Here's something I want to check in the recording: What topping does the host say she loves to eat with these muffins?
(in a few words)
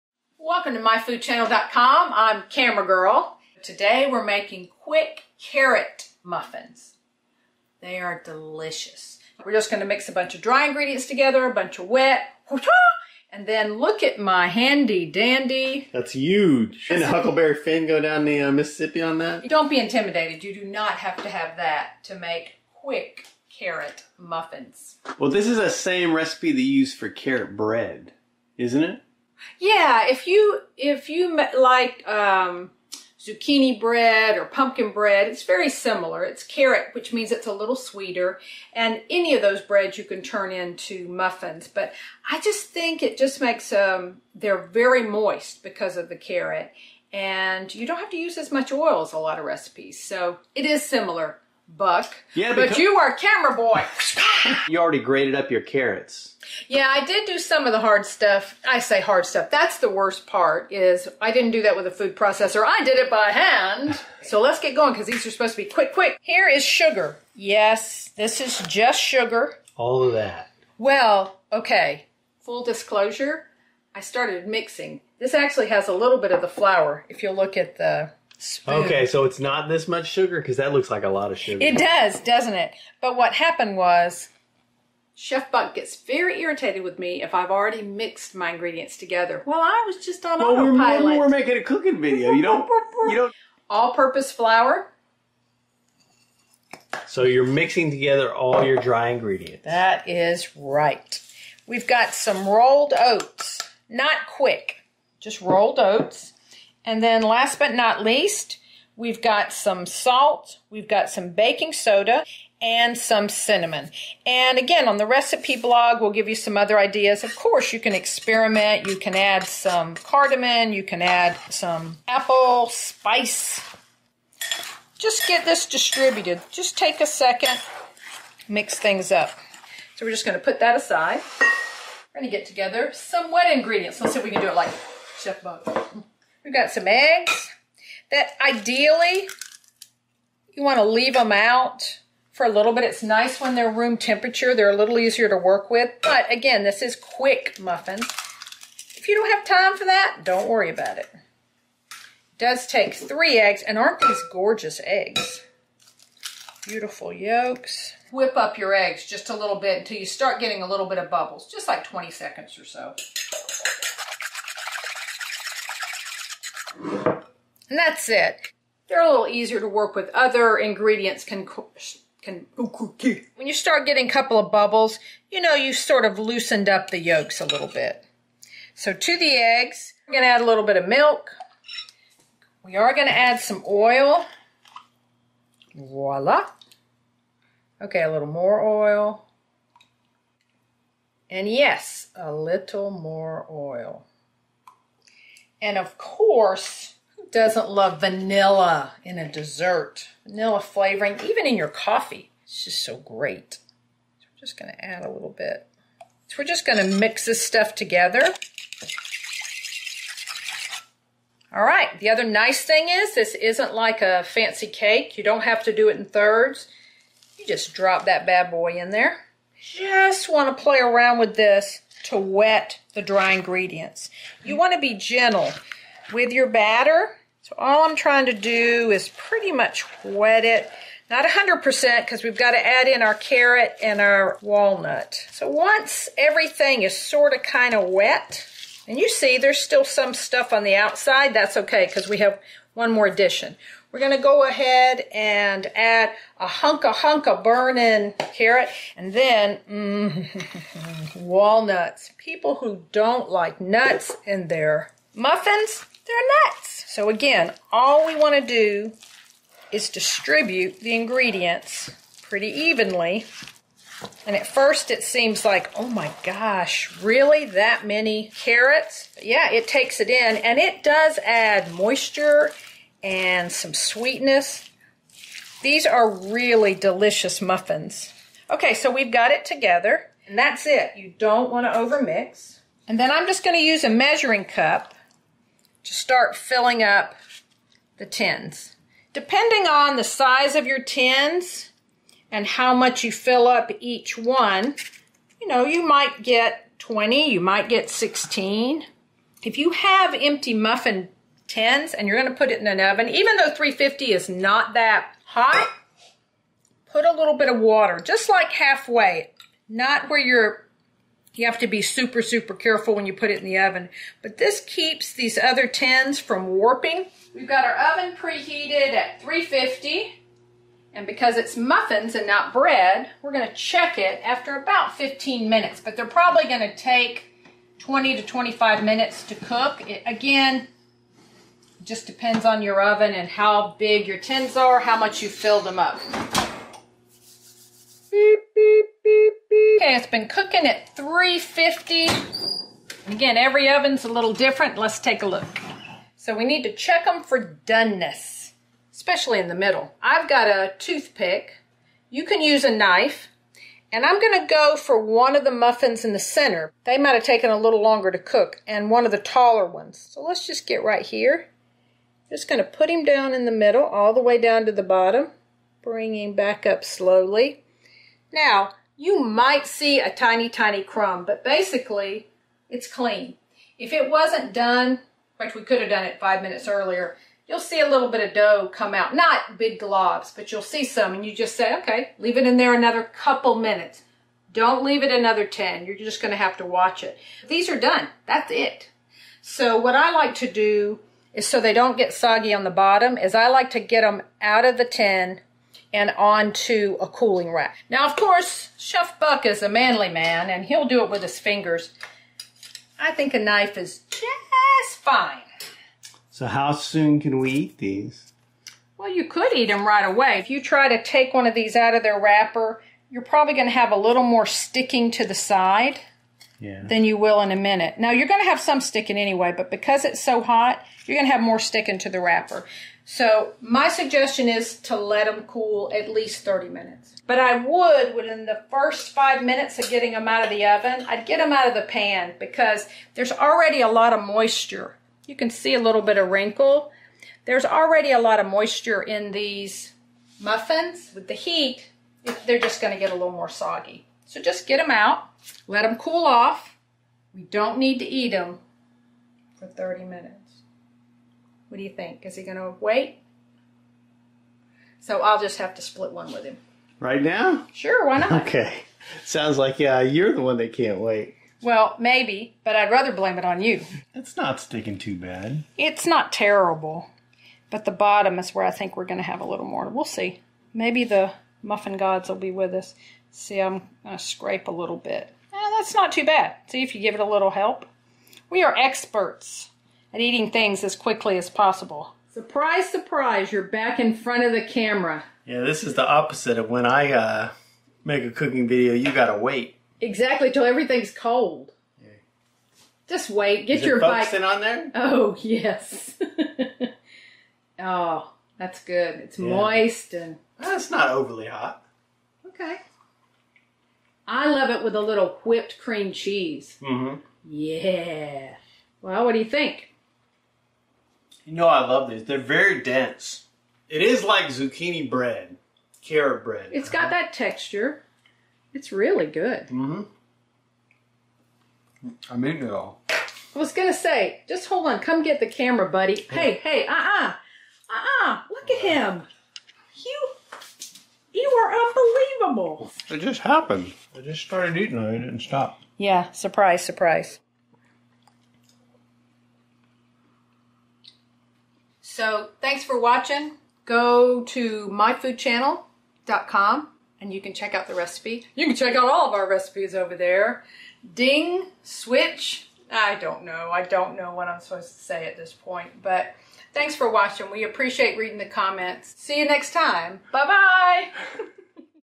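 Whipped cream cheese.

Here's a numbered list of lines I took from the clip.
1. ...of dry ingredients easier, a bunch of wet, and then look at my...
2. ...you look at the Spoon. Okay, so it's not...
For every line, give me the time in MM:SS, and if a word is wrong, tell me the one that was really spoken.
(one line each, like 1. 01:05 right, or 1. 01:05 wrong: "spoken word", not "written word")
1. 00:10 wrong: "together", not "easier"
2. 01:17 right.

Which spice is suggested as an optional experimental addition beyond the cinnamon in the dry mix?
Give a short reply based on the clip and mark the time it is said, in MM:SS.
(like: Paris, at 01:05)
Cardamom, at 01:59.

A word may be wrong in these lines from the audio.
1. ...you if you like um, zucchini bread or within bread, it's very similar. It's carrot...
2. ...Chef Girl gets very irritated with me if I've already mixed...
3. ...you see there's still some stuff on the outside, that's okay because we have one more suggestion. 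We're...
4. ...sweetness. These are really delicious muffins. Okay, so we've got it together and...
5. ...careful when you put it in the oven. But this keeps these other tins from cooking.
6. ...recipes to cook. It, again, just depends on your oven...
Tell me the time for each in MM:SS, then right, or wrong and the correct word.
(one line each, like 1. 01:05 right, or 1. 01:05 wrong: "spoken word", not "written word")
1. 00:30 wrong: "pumpkin", not "within"
2. 01:25 wrong: "Buck", not "Girl"
3. 03:58 wrong: "addition", not "suggestion"
4. 04:33 right
5. 05:12 wrong: "warping", not "cooking"
6. 05:28 wrong: "minutes", not "recipes".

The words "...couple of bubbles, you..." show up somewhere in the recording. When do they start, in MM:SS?
02:54.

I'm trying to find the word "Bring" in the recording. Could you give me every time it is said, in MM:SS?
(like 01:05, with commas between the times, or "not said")
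06:05.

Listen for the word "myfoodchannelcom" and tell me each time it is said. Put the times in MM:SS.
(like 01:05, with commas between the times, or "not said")
00:00, 09:04.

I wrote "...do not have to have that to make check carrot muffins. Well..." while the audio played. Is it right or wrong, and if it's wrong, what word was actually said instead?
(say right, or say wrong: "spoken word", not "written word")
wrong: "quick", not "check".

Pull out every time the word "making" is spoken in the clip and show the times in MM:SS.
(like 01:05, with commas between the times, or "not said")
00:04, 01:31.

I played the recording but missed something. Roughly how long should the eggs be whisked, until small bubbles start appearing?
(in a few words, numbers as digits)
20 seconds.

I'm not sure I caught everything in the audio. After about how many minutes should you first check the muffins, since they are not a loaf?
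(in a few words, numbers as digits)
15 minutes.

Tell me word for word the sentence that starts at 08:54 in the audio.
I just started eating and I didn't stop.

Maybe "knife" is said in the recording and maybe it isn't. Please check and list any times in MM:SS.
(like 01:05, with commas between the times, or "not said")
05:52, 06:43.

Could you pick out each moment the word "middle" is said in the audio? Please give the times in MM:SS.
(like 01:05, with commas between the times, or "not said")
05:49, 06:03.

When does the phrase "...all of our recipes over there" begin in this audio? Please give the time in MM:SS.
09:09.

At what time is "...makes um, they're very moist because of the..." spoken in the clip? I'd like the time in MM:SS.
00:43.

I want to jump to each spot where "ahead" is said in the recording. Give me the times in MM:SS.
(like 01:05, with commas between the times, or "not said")
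04:04.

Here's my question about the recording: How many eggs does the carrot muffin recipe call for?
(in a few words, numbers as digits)
3.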